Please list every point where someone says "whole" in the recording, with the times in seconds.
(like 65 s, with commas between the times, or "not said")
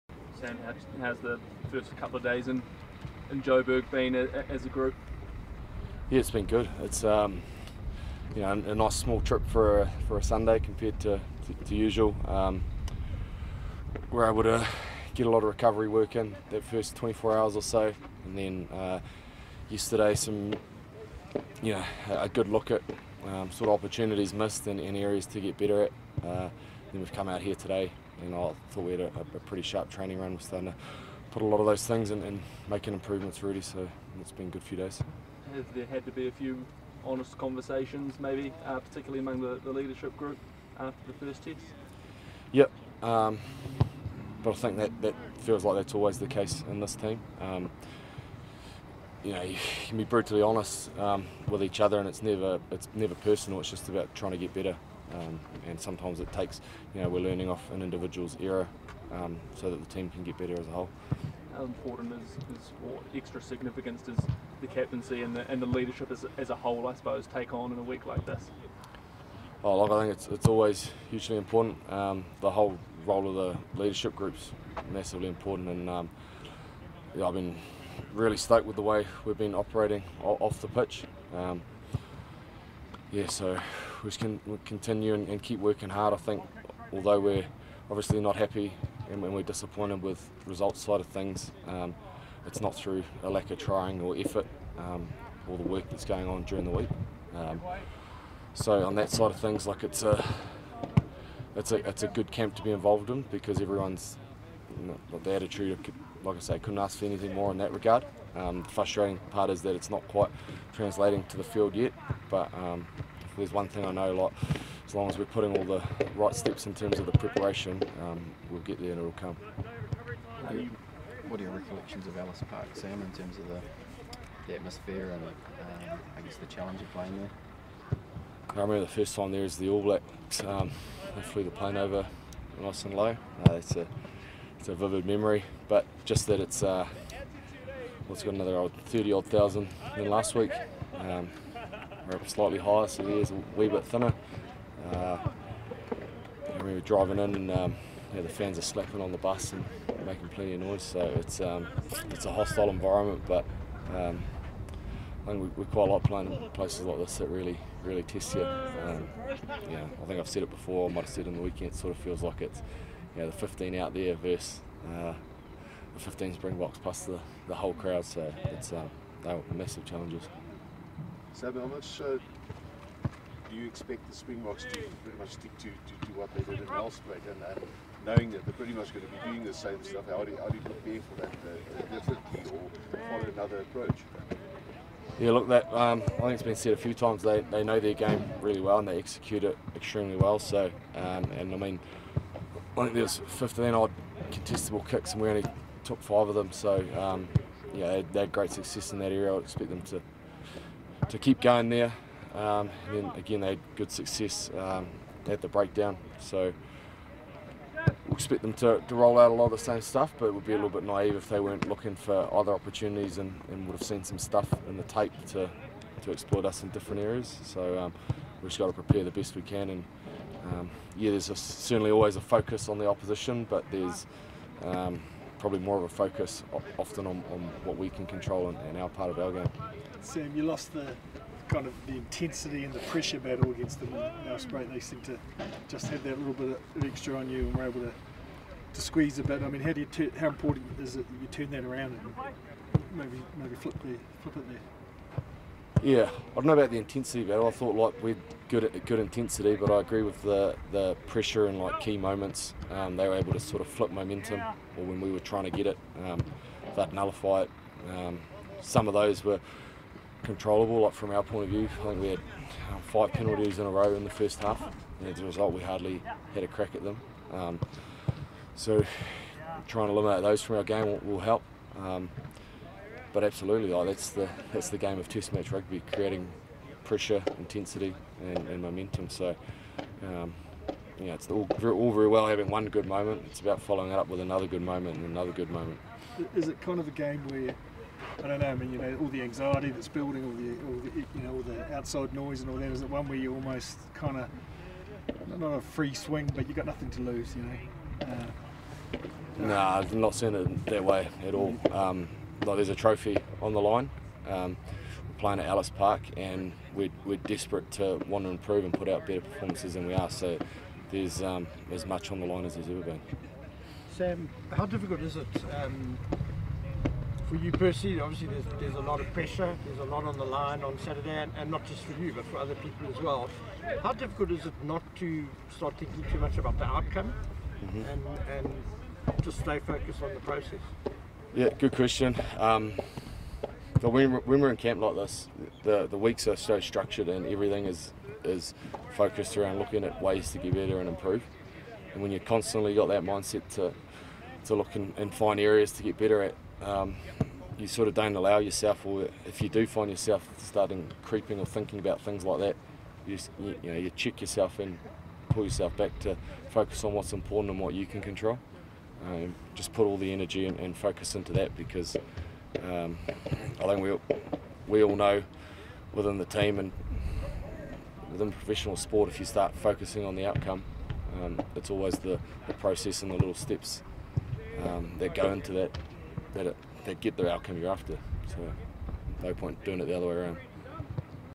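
60 s, 66 s, 72 s, 167 s.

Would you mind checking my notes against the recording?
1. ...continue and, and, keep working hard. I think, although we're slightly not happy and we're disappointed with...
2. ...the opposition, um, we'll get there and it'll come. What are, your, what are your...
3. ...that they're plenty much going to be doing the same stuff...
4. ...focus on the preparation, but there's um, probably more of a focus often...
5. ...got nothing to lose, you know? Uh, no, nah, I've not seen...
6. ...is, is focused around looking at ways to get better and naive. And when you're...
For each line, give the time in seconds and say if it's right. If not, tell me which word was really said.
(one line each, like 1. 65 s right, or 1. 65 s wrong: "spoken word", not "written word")
1. 84 s wrong: "obviously", not "slightly"
2. 117 s wrong: "preparation", not "opposition"
3. 178 s wrong: "pretty", not "plenty"
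4. 222 s wrong: "opposition", not "preparation"
5. 296 s right
6. 337 s wrong: "improve", not "naive".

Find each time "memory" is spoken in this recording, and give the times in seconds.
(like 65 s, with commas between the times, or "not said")
135 s.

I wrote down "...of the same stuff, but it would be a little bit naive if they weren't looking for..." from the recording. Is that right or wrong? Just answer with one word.
right.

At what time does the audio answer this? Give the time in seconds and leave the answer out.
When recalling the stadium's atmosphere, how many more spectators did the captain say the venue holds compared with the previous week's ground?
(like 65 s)
138 s.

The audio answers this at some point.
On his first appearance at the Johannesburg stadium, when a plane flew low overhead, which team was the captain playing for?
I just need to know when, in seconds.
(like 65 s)
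129 s.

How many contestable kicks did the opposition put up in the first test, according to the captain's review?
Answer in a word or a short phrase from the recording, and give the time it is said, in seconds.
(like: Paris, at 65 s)
15, at 193 s.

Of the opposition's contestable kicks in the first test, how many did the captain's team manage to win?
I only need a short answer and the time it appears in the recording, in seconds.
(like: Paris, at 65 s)
5, at 196 s.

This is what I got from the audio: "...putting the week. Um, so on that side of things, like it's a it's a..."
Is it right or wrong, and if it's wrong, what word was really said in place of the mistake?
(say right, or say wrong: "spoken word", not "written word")
wrong: "during", not "putting".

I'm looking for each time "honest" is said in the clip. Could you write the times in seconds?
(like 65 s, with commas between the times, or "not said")
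37 s, 50 s.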